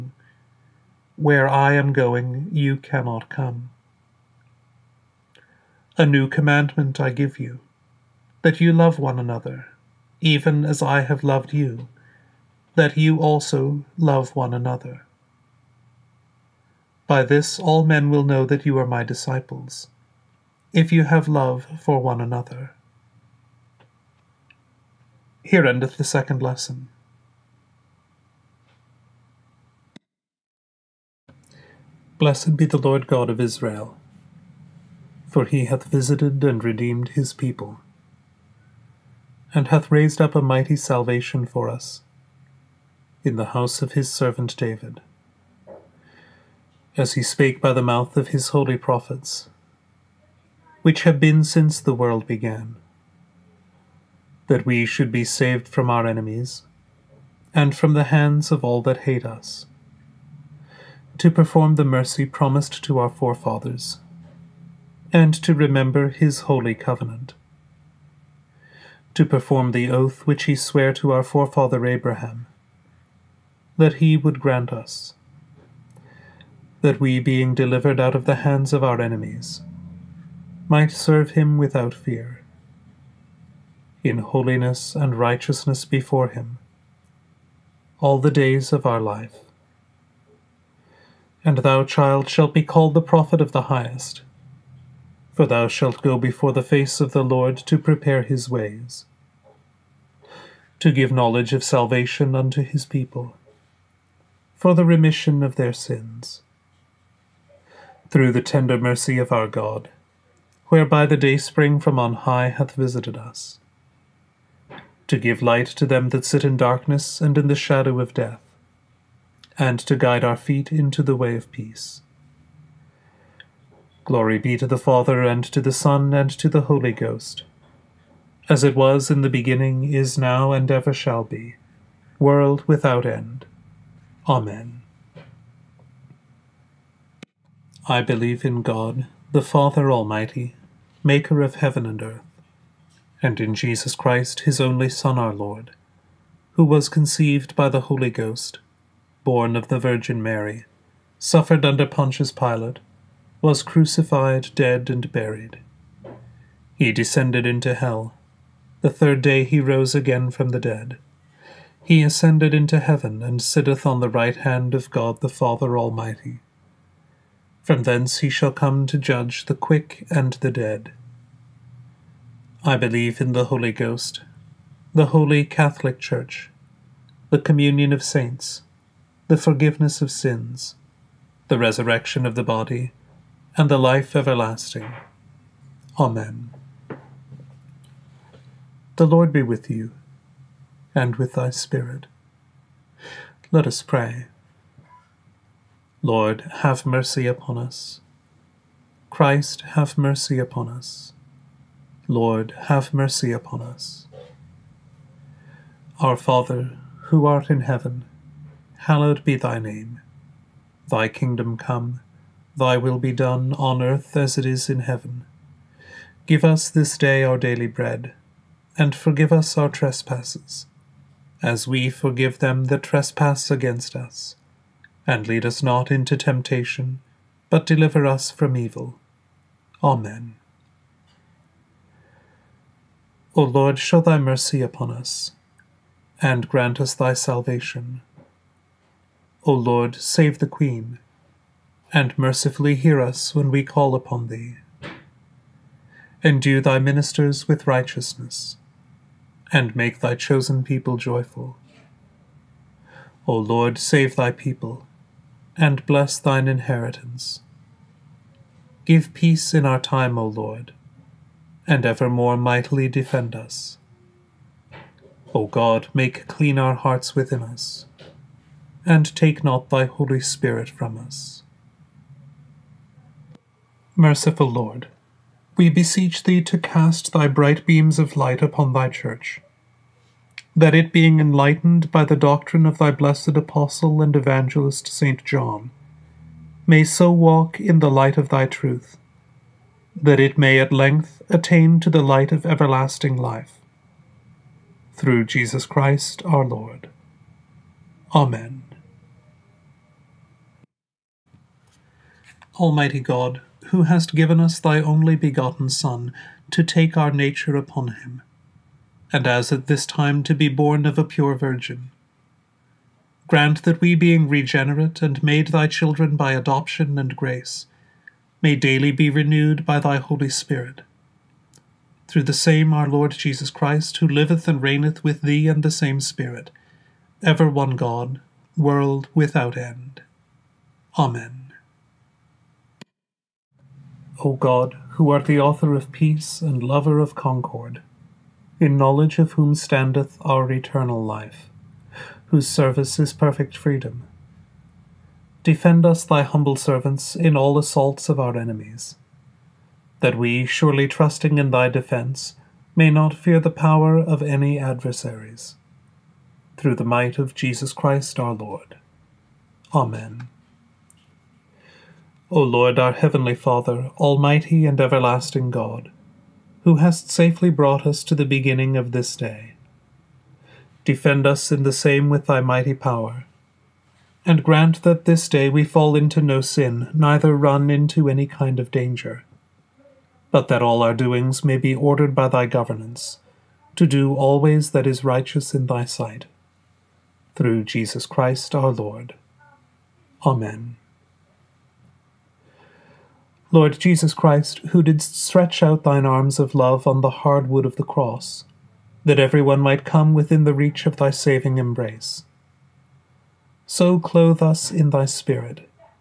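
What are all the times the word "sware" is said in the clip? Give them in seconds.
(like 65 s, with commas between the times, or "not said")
70 s.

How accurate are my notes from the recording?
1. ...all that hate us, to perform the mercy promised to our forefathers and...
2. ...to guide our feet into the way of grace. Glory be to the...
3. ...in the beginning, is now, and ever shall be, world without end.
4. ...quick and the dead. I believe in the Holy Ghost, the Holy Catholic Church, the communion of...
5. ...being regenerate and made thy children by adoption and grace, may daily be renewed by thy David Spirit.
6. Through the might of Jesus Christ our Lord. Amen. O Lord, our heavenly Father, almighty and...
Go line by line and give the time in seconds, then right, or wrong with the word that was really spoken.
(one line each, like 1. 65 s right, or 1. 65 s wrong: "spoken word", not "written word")
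1. 58 s right
2. 119 s wrong: "peace", not "grace"
3. 129 s right
4. 169 s right
5. 313 s wrong: "Holy", not "David"
6. 356 s right.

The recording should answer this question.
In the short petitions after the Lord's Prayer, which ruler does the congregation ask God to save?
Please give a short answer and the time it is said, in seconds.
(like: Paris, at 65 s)
the Queen, at 240 s.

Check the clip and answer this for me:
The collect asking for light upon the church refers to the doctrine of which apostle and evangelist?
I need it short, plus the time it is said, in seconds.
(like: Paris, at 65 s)
St. John, at 284 s.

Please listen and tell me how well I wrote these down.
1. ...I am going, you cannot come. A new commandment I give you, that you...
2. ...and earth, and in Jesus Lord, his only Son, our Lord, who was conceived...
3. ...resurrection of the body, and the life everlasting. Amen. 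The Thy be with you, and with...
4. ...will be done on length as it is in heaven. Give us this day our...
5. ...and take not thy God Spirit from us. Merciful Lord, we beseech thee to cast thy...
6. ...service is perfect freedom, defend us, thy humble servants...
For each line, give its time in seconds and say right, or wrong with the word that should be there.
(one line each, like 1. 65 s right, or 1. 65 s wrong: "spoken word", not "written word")
1. 1 s right
2. 141 s wrong: "Christ", not "Lord"
3. 181 s wrong: "Lord", not "Thy"
4. 212 s wrong: "earth", not "length"
5. 268 s wrong: "Holy", not "God"
6. 342 s right.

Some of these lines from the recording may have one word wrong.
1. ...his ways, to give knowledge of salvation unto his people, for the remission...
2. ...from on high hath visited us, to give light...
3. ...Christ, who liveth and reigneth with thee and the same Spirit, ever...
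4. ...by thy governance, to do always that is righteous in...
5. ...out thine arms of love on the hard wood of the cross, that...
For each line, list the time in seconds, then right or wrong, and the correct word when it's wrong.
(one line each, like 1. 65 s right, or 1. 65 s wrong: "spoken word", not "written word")
1. 98 s right
2. 111 s right
3. 323 s right
4. 382 s right
5. 395 s right.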